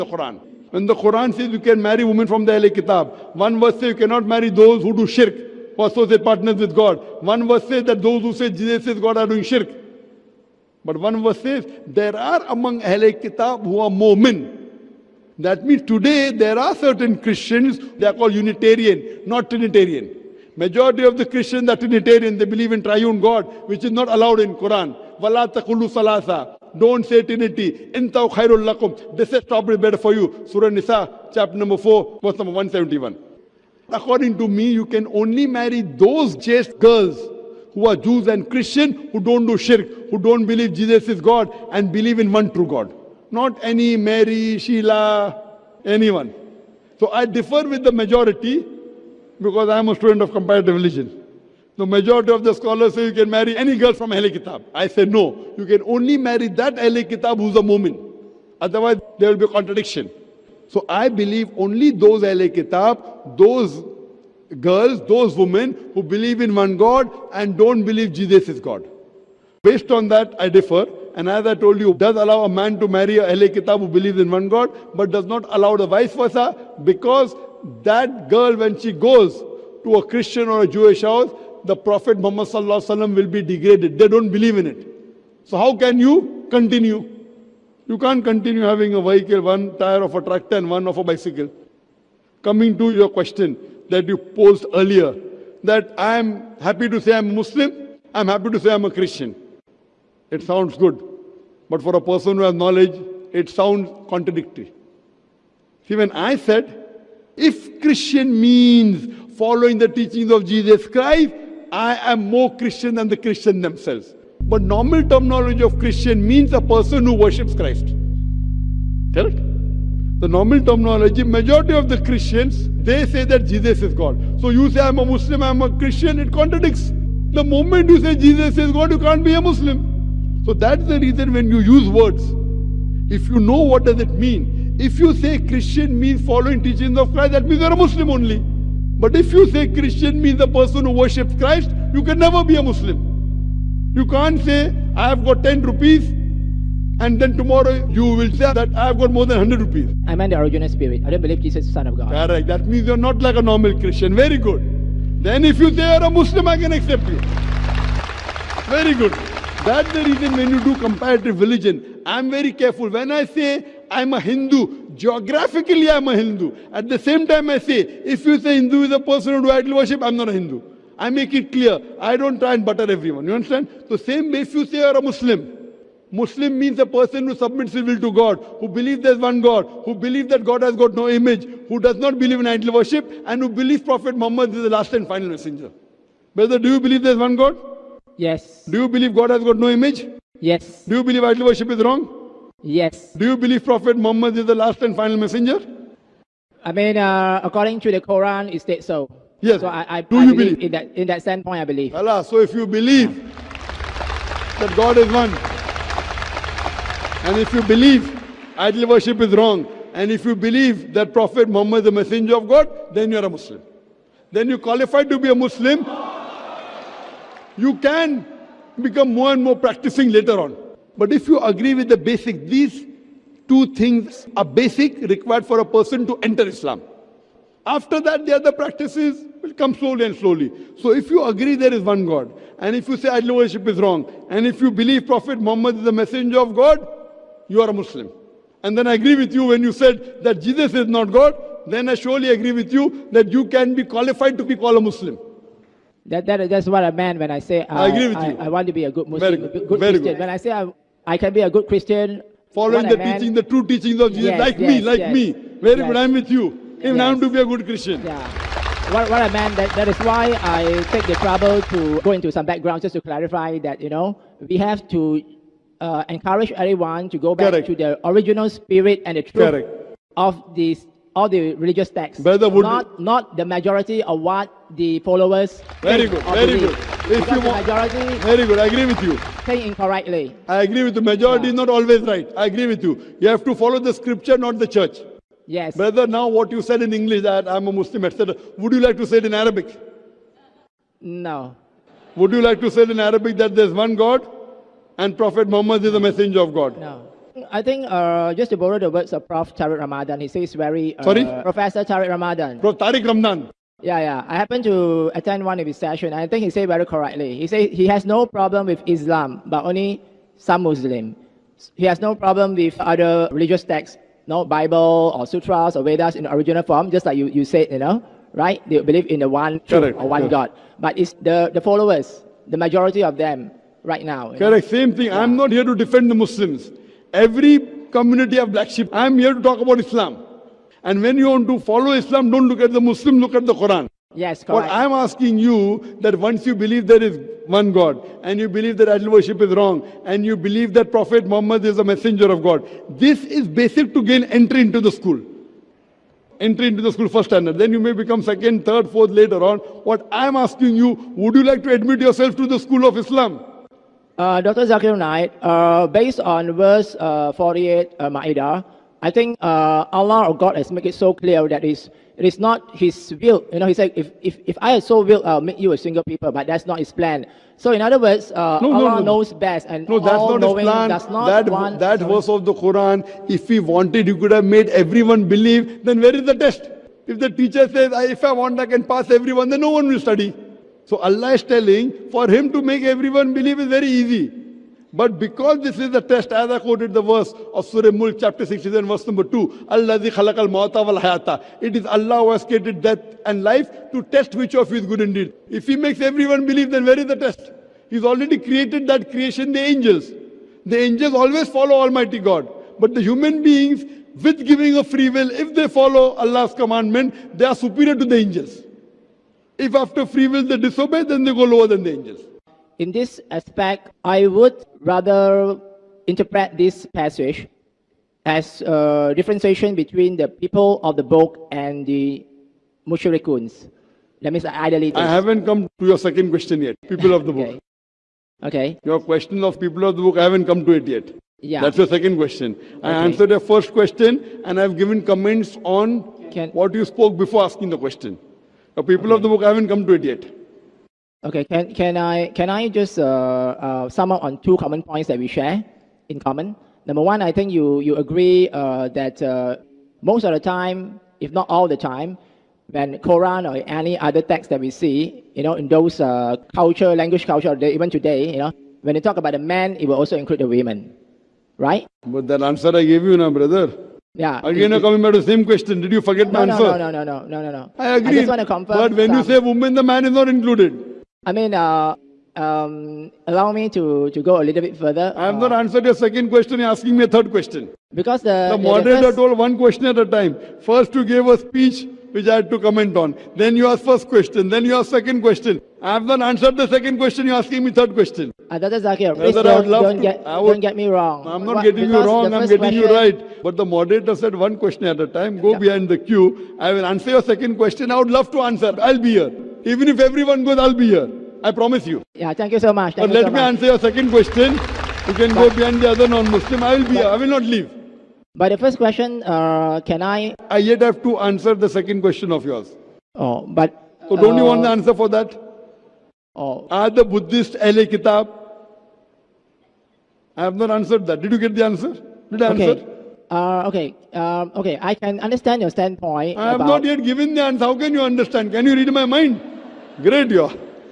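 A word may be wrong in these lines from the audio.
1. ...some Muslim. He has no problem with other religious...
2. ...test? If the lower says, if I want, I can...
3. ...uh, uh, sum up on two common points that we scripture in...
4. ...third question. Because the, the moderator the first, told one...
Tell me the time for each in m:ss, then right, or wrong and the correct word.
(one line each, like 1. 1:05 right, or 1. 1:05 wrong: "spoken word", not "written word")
1. 5:10 right
2. 6:16 wrong: "teacher", not "lower"
3. 7:22 wrong: "share", not "scripture"
4. 7:57 right.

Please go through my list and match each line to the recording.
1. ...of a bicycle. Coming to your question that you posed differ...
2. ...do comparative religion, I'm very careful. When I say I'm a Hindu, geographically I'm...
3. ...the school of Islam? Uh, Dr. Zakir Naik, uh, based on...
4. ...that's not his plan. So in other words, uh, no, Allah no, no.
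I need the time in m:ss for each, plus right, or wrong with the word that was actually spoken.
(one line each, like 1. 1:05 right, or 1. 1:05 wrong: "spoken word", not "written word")
1. 1:30 wrong: "earlier", not "differ"
2. 2:40 right
3. 5:52 right
4. 6:06 right.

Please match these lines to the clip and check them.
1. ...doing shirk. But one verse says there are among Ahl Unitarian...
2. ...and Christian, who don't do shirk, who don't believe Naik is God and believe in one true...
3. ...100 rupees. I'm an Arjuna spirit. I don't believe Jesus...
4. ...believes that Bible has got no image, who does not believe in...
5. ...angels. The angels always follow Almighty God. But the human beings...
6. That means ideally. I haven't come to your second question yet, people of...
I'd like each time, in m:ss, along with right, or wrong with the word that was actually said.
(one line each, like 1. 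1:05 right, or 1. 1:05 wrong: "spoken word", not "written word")
1. 0:09 wrong: "Kitab", not "Unitarian"
2. 0:38 wrong: "Jesus", not "Naik"
3. 2:29 right
4. 2:59 wrong: "God", not "Bible"
5. 6:39 right
6. 7:04 right.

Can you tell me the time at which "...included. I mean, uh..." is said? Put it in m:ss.
7:50.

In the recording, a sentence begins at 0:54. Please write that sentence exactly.
I say no, you can only marry that Ahle Kitab who's a woman.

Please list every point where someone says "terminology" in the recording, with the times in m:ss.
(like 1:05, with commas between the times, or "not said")
1:55, 2:00.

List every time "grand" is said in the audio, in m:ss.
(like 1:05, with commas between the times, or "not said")
not said.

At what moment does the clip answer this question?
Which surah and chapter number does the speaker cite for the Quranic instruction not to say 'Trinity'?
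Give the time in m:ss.
0:30.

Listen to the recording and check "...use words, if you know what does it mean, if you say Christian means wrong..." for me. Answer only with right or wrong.
wrong.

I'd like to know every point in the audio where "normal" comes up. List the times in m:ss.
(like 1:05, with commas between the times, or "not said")
1:54, 2:00, 2:33.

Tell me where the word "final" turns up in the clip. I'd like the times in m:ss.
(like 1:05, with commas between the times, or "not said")
3:05, 3:14.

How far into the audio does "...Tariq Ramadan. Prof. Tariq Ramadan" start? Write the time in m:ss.
5:01.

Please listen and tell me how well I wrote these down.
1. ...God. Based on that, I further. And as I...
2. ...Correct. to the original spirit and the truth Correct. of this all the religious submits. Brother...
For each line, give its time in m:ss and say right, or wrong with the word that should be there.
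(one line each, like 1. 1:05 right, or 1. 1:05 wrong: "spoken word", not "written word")
1. 1:08 wrong: "differ", not "further"
2. 4:27 wrong: "texts", not "submits".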